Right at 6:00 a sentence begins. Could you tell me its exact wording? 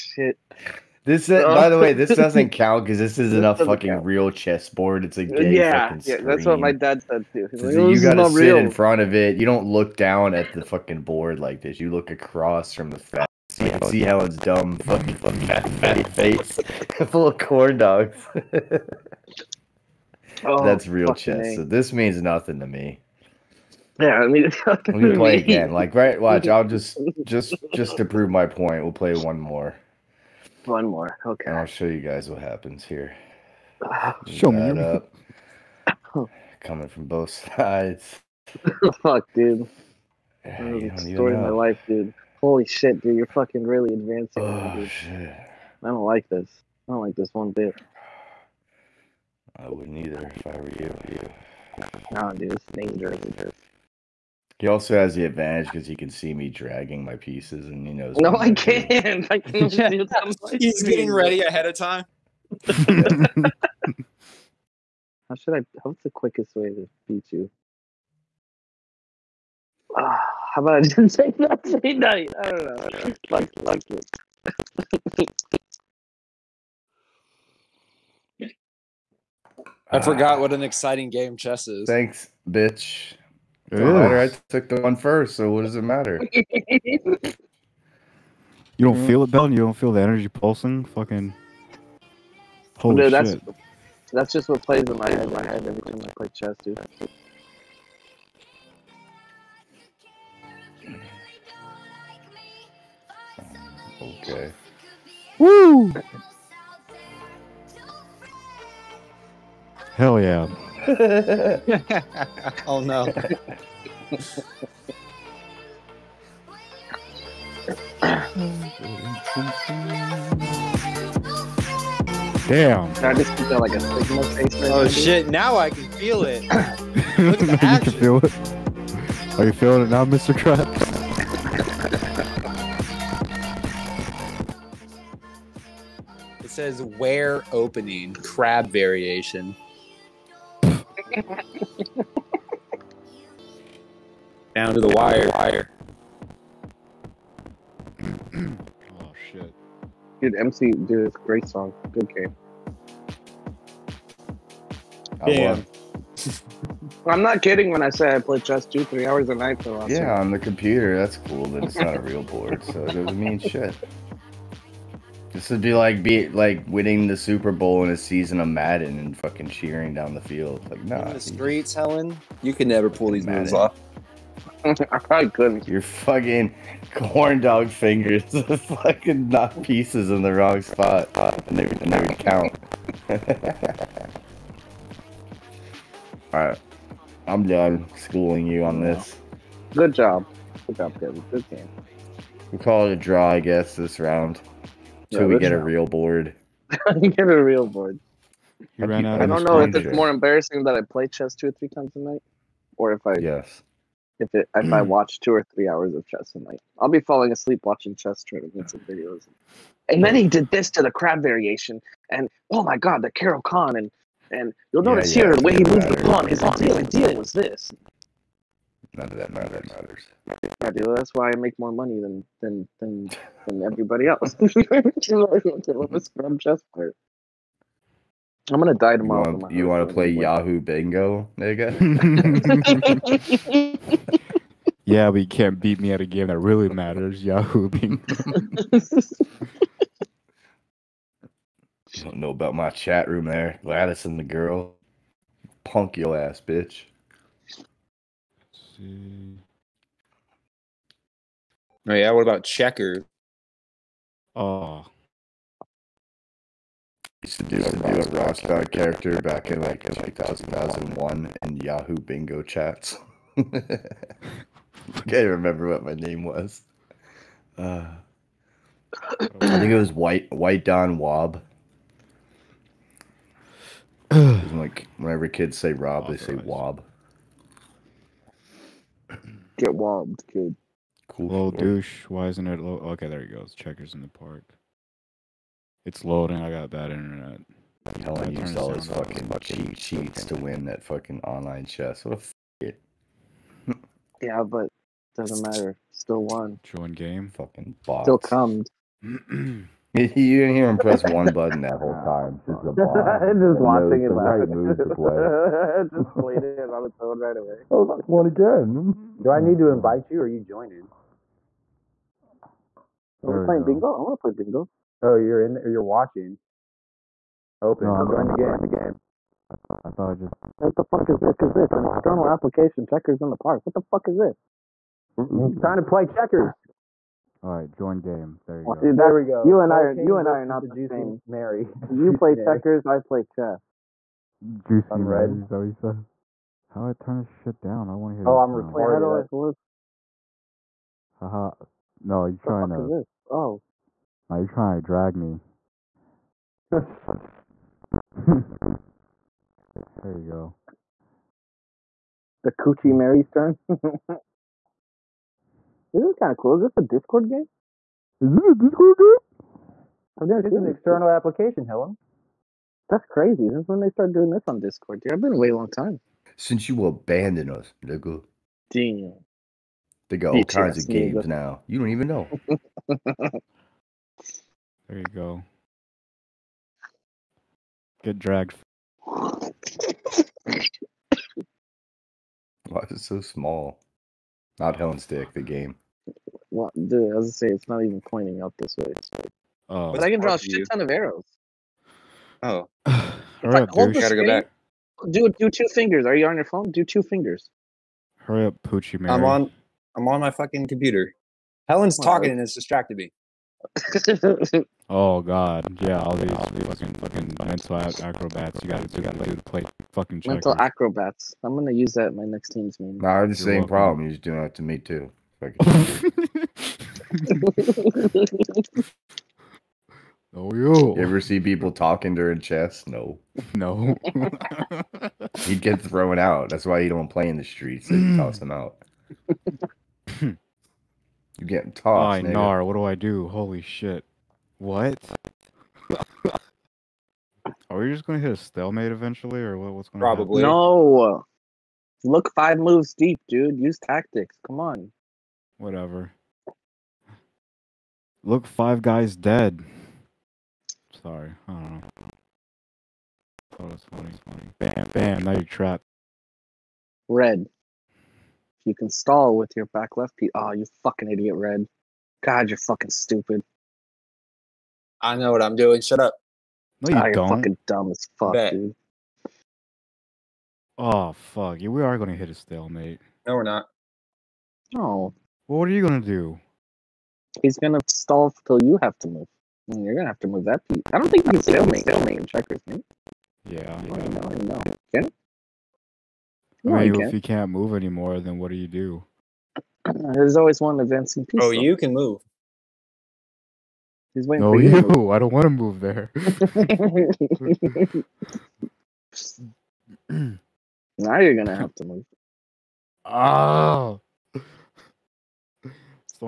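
I've never this is an external application, Helen.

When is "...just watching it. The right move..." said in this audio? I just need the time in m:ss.
5:03.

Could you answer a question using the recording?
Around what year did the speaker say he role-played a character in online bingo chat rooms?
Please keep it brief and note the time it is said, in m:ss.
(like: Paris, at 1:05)
2001, at 4:20.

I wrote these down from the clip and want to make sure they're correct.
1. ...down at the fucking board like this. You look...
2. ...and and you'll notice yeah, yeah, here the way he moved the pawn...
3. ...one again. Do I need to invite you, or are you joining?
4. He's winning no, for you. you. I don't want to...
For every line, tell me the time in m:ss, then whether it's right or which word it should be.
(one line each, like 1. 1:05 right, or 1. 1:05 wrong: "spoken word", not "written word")
1. 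0:09 right
2. 3:33 right
3. 5:08 right
4. 8:14 wrong: "waiting", not "winning".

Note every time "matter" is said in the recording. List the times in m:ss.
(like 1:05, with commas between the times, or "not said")
1:25, 3:39, 3:56, 4:55.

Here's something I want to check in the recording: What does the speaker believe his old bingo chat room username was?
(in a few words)
White Don Wob.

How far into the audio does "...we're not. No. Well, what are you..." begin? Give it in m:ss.
7:53.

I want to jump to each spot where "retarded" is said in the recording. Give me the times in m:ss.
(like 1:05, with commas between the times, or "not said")
5:38.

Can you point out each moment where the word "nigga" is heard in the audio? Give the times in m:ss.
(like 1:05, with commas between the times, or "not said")
3:51, 6:07.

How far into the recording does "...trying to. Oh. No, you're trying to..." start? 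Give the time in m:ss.
5:42.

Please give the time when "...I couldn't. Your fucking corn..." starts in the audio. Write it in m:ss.
2:55.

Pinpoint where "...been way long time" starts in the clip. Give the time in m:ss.
6:05.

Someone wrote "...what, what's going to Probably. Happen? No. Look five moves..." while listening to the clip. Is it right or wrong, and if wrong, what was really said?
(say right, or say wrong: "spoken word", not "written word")
right.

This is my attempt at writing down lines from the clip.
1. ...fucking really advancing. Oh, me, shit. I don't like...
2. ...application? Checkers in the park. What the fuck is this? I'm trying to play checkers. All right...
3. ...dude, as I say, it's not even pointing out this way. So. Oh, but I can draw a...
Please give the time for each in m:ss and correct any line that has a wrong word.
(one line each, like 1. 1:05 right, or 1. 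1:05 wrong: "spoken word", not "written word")
1. 0:43 right
2. 5:22 right
3. 6:26 right.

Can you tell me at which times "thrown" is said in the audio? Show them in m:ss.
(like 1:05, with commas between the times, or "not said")
7:05.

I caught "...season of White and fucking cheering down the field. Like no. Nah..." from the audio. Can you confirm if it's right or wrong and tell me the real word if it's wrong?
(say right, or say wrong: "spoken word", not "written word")
wrong: "Madden", not "White".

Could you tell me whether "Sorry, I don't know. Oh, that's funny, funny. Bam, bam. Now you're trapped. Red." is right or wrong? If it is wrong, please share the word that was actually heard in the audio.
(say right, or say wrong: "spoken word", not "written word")
right.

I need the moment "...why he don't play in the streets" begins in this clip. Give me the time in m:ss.
7:06.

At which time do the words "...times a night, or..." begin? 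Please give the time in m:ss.
3:21.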